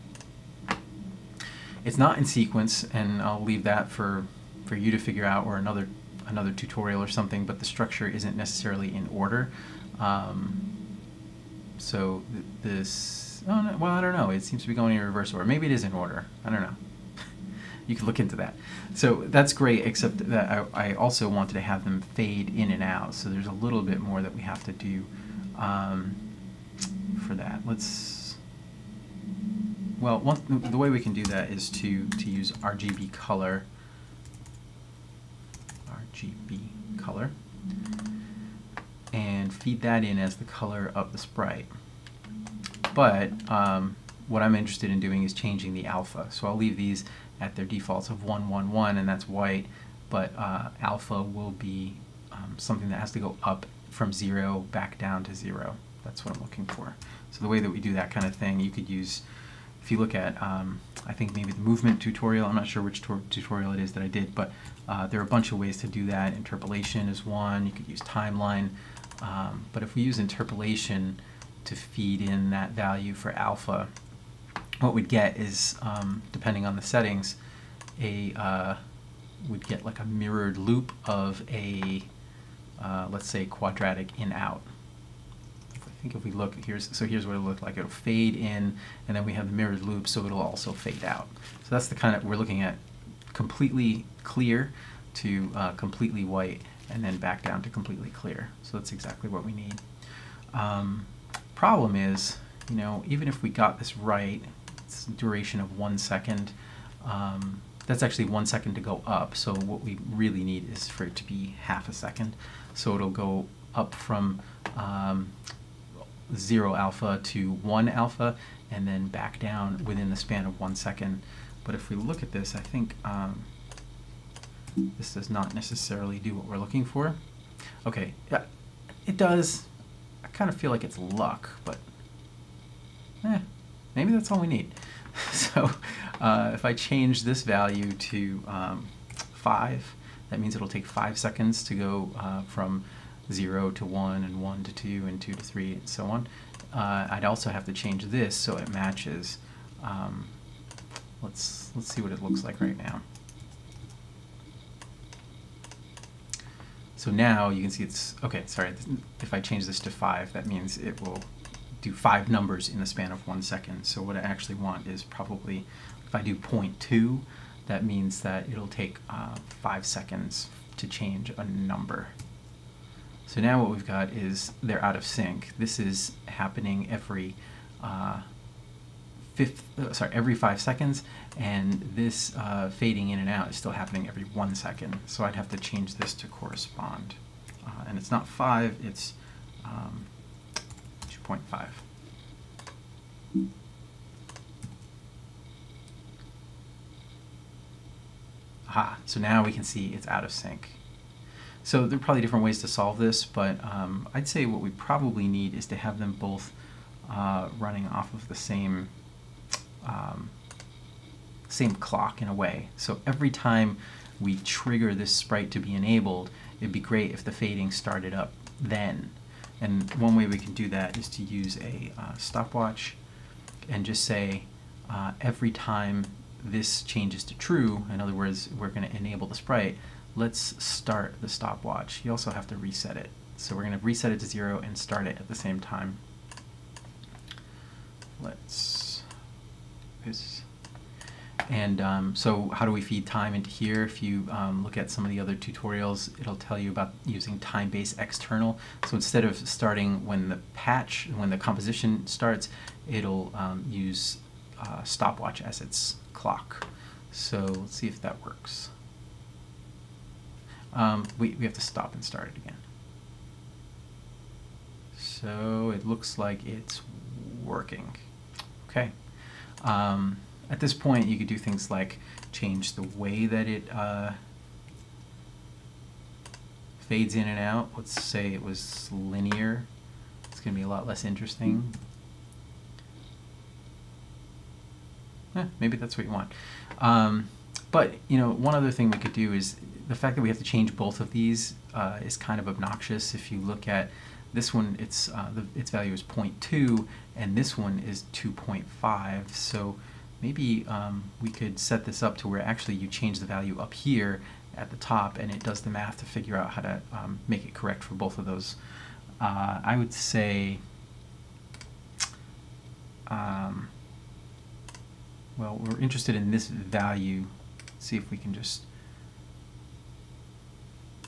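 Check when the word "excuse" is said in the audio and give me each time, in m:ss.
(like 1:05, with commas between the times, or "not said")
not said.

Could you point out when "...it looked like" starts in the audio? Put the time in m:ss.
1:27.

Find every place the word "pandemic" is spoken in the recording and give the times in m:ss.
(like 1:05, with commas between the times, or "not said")
not said.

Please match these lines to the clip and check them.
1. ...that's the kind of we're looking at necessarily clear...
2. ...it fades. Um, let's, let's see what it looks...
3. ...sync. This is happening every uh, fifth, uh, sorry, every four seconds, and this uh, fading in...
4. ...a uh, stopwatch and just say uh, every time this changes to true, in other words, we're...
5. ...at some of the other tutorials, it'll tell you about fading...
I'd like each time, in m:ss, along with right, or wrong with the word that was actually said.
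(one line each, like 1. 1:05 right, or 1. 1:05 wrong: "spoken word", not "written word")
1. 1:31 wrong: "completely", not "necessarily"
2. 2:28 wrong: "matches", not "fades"
3. 2:55 wrong: "five", not "four"
4. 3:41 right
5. 4:04 wrong: "using", not "fading".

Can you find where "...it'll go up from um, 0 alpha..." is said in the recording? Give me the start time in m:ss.
1:52.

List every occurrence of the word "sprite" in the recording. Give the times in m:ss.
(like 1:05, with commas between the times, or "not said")
0:41, 3:35, 3:49.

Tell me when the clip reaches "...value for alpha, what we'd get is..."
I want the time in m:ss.
1:12.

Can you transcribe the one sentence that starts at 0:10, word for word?
Um, so th this, oh no, well, I don't know.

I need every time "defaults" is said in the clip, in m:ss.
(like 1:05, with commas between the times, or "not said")
0:47.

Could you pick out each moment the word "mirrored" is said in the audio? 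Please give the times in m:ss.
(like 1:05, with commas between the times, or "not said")
1:20, 1:29.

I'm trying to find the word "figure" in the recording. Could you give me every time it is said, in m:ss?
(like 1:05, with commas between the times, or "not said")
0:04, 5:06.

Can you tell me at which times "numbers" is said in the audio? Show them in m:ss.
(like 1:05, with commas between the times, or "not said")
2:42, 2:51.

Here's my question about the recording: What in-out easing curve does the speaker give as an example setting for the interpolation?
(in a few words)
quadratic.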